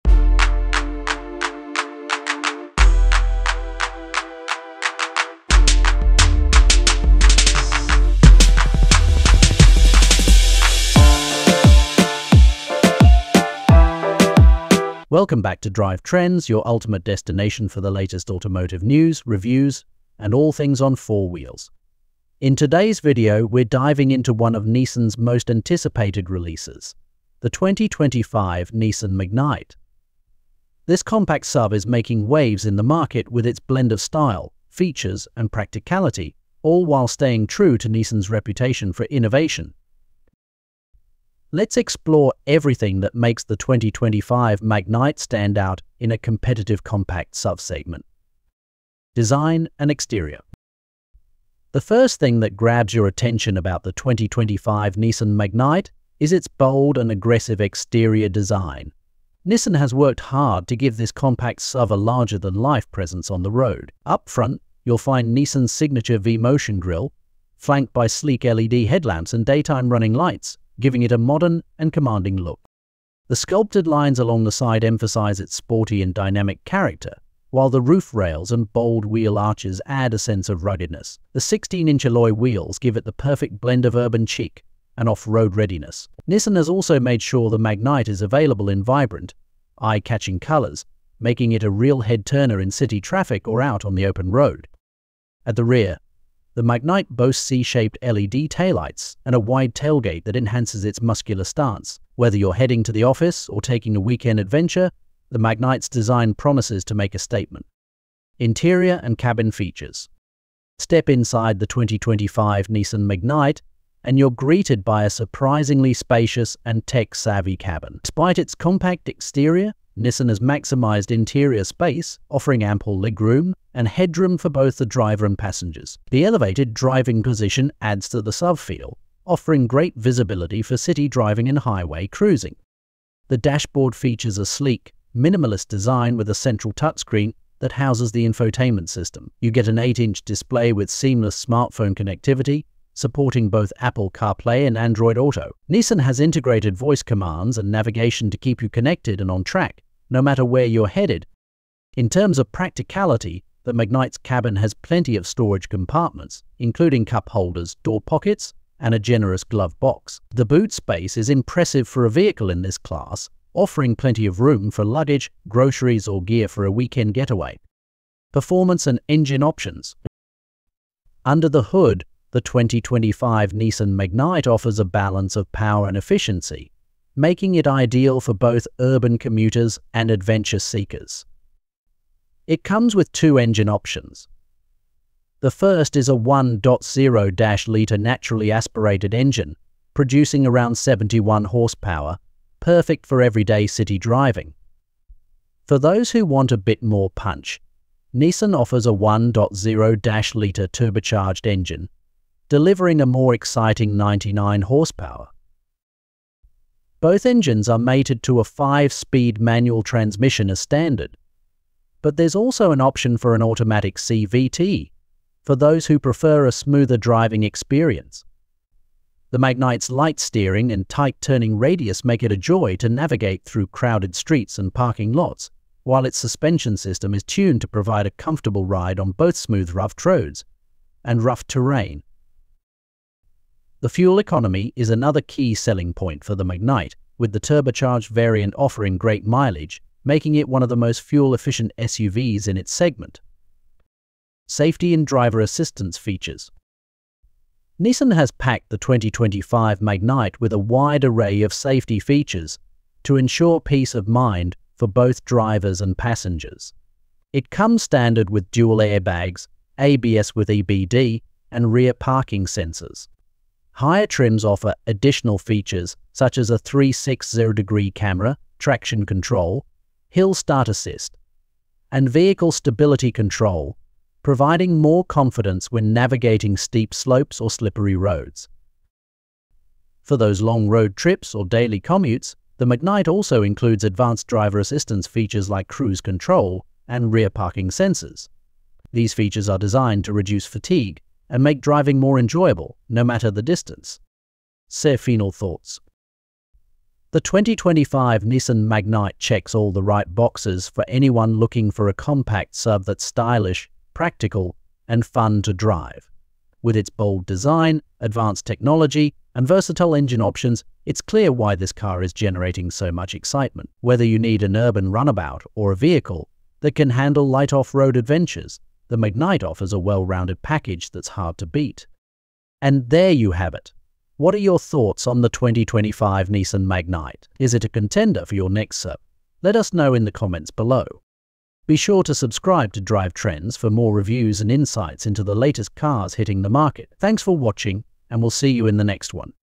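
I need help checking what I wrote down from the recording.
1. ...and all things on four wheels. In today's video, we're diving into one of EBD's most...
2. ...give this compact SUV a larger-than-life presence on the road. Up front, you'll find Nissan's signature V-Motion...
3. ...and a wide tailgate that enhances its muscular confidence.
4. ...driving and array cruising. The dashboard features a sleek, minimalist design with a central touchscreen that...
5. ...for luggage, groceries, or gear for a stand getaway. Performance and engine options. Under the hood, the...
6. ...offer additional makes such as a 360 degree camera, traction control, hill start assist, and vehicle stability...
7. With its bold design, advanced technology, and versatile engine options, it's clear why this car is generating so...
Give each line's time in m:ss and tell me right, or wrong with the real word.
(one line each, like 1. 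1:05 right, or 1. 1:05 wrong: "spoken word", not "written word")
1. 0:20 wrong: "Nissan", not "EBD"
2. 1:00 right
3. 1:39 wrong: "stance", not "confidence"
4. 2:11 wrong: "highway", not "array"
5. 2:44 wrong: "weekend", not "stand"
6. 4:24 wrong: "features", not "makes"
7. 5:06 right.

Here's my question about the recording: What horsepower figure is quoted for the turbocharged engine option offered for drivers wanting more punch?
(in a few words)
99 horsepower.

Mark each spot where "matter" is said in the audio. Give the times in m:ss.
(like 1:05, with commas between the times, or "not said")
2:30, 4:53.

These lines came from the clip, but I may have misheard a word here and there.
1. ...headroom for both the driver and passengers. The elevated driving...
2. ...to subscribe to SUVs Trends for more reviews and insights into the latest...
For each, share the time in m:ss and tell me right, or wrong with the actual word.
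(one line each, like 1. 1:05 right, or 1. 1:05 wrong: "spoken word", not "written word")
1. 2:03 right
2. 5:32 wrong: "Drive", not "SUVs".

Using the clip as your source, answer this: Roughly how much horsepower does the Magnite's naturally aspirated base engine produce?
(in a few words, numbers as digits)
71 horsepower.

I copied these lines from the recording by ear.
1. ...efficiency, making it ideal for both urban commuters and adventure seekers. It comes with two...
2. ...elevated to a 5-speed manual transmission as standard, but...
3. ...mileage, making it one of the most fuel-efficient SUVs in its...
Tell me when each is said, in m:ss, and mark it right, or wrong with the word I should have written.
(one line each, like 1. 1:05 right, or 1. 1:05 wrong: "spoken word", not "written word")
1. 2:55 right
2. 3:27 wrong: "mated", not "elevated"
3. 3:59 right.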